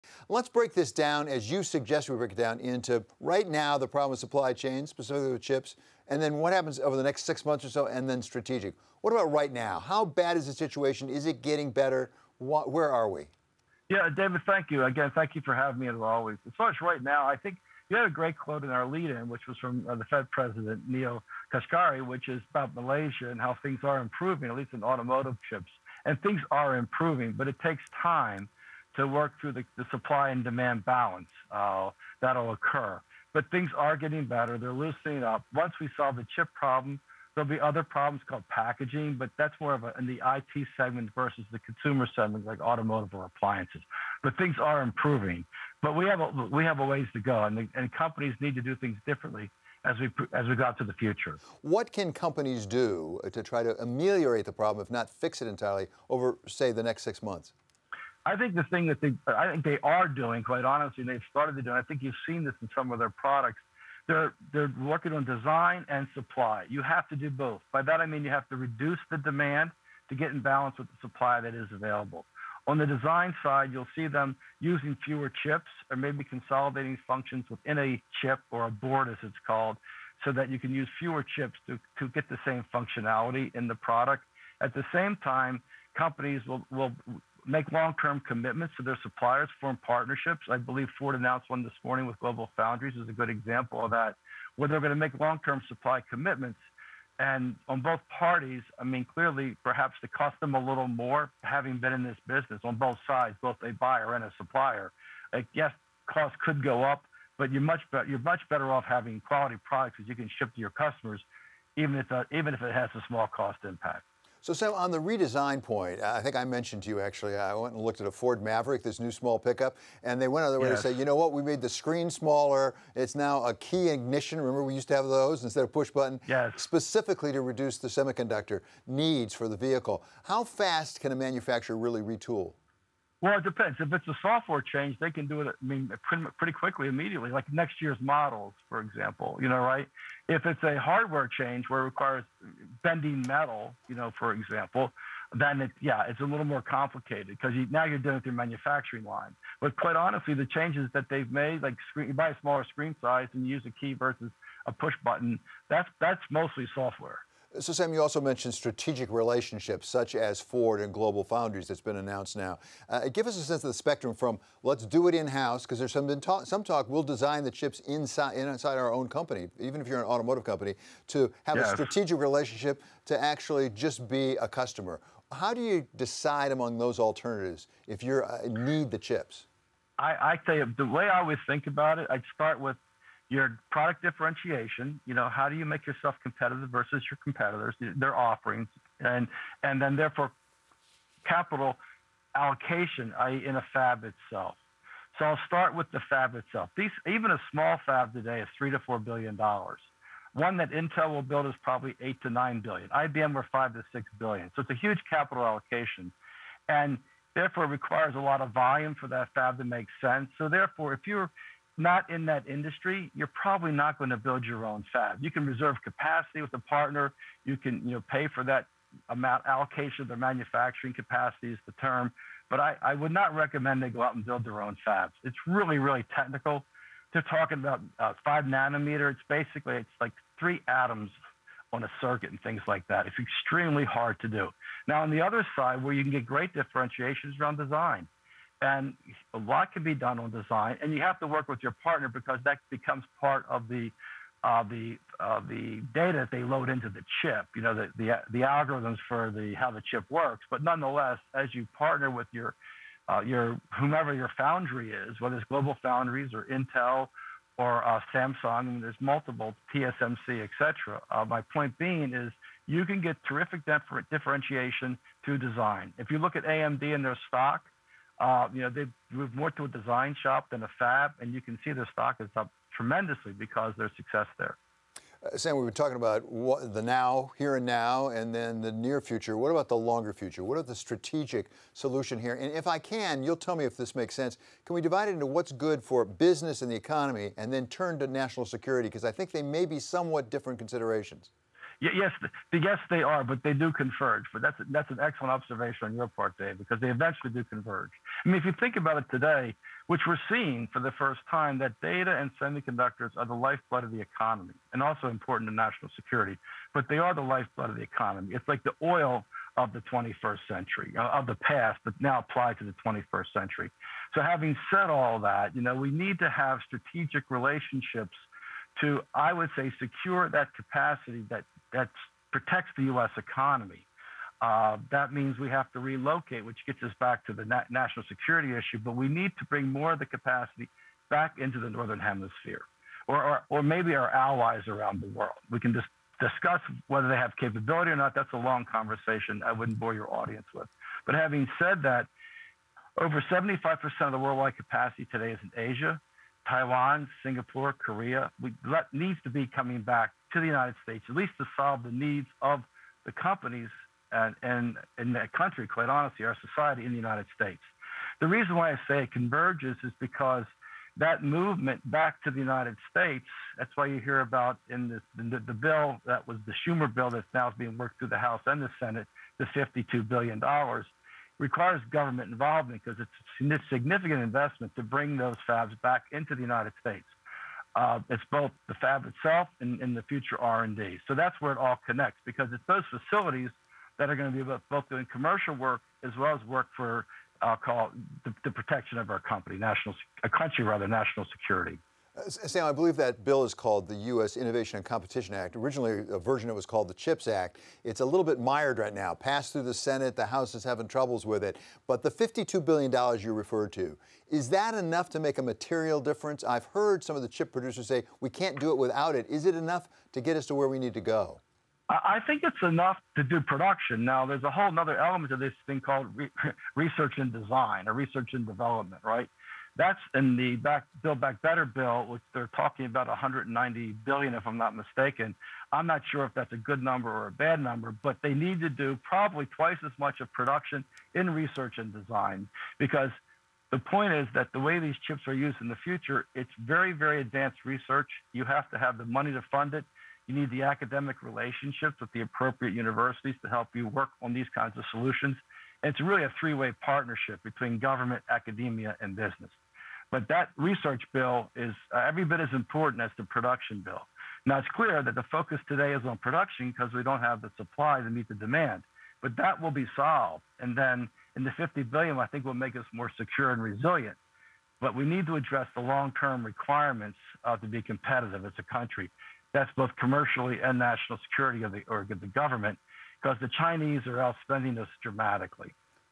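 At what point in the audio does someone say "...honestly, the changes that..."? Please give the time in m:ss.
2:29.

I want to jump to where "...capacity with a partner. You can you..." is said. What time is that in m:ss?
3:35.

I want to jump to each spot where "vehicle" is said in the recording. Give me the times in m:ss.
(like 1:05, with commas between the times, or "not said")
2:09.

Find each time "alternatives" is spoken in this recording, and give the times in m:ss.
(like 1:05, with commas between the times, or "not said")
2:56.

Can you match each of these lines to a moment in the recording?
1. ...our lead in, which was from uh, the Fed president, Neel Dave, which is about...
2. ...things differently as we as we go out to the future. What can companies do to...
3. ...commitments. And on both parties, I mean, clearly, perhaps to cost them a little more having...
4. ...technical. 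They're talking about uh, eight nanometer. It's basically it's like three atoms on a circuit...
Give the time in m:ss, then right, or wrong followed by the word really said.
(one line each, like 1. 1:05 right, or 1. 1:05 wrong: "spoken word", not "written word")
1. 0:18 wrong: "Kashkari", not "Dave"
2. 0:48 right
3. 1:36 right
4. 3:46 wrong: "five", not "eight".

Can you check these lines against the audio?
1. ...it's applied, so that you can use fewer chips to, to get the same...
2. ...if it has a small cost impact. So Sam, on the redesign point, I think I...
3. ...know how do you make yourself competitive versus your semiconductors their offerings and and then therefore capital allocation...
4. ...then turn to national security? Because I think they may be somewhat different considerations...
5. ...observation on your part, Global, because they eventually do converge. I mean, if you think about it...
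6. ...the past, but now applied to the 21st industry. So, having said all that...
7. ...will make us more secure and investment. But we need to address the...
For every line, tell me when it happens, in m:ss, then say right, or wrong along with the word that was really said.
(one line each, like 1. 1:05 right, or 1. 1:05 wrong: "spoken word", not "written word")
1. 1:19 wrong: "called", not "applied"
2. 1:52 right
3. 3:05 wrong: "competitors", not "semiconductors"
4. 4:47 right
5. 4:55 wrong: "Dave", not "Global"
6. 5:11 wrong: "century", not "industry"
7. 7:42 wrong: "resilient", not "investment".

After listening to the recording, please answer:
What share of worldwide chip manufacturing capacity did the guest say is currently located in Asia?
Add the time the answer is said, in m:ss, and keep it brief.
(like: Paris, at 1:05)
Over 75%, at 5:42.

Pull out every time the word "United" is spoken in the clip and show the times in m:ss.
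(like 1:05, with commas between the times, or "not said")
5:50, 5:56, 6:02, 6:16.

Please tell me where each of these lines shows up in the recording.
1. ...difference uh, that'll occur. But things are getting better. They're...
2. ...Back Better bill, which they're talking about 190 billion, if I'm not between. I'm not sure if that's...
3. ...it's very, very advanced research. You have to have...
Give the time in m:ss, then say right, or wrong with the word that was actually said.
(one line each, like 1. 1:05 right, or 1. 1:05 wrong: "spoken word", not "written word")
1. 0:30 wrong: "balance", not "difference"
2. 7:01 wrong: "mistaken", not "between"
3. 7:16 right.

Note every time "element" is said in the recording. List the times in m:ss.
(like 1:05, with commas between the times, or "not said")
6:54.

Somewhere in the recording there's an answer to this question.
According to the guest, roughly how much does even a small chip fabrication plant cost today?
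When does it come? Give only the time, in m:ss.
3:18.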